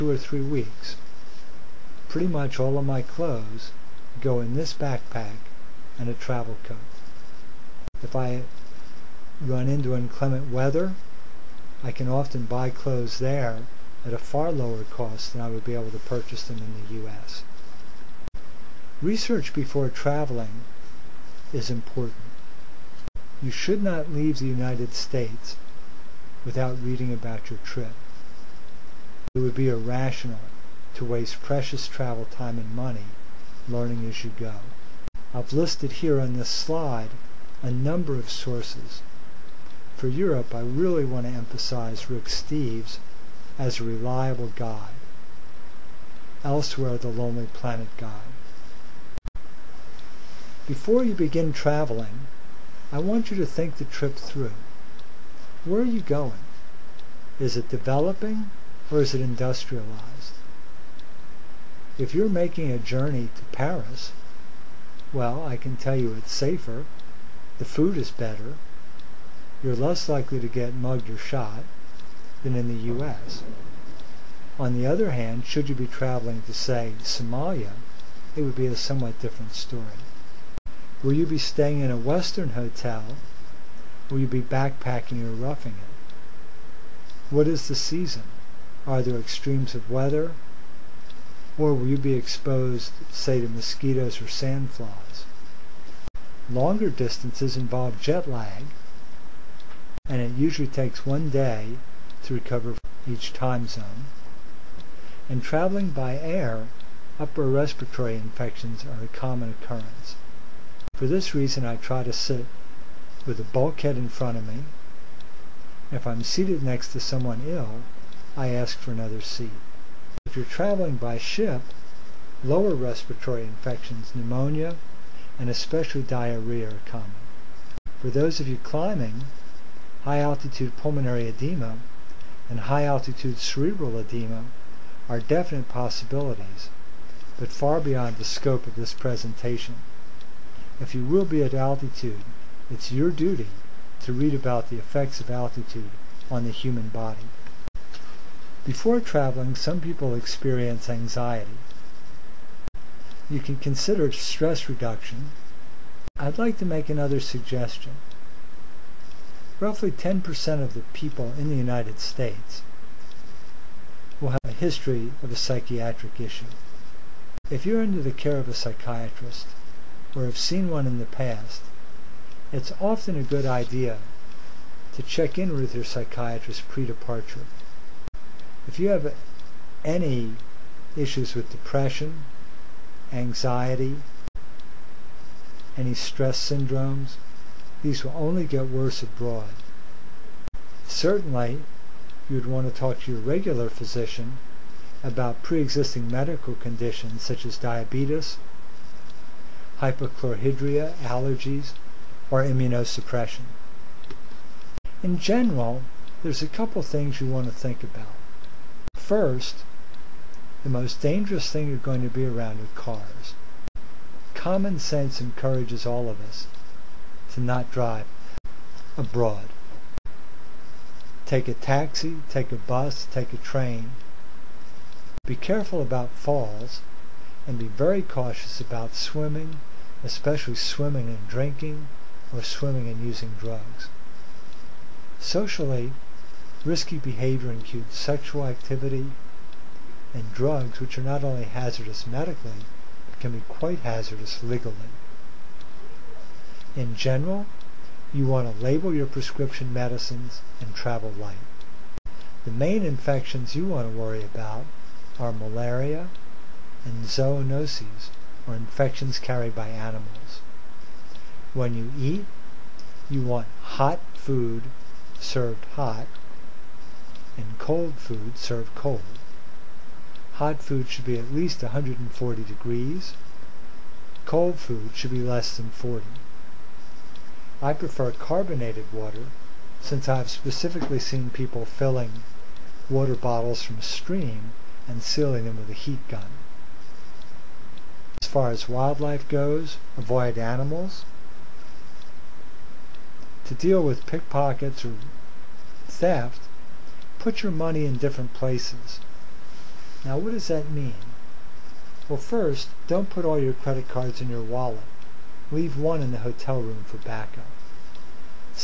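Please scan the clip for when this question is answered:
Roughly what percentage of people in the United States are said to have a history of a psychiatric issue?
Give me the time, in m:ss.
2:39.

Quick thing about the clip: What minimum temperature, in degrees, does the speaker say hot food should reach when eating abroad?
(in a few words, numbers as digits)
140.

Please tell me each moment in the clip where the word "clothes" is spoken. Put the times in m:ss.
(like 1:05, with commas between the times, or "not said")
0:03, 0:12.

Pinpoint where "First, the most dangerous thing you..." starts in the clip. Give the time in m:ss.
3:28.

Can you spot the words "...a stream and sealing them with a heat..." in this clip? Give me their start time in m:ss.
4:43.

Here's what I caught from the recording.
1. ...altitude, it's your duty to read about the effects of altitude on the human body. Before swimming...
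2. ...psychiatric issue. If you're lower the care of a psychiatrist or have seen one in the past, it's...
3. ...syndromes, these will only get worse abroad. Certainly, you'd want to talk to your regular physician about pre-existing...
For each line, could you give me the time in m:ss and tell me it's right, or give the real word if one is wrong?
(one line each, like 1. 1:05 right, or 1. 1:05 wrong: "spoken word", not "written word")
1. 2:21 wrong: "traveling", not "swimming"
2. 2:45 wrong: "under", not "lower"
3. 3:06 right.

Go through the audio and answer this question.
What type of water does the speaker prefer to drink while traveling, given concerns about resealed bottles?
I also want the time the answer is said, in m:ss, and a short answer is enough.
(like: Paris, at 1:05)
carbonated water, at 4:38.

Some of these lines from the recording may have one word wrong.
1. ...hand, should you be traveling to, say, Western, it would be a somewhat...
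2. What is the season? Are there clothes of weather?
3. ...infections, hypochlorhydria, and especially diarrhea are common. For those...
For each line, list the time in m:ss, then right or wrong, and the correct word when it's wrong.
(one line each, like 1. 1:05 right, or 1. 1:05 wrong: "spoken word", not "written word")
1. 1:15 wrong: "Somalia", not "Western"
2. 1:27 wrong: "extremes", not "clothes"
3. 2:03 wrong: "pneumonia", not "hypochlorhydria".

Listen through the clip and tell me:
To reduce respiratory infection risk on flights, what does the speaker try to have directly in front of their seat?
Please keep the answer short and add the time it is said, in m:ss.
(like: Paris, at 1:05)
bulkhead, at 1:53.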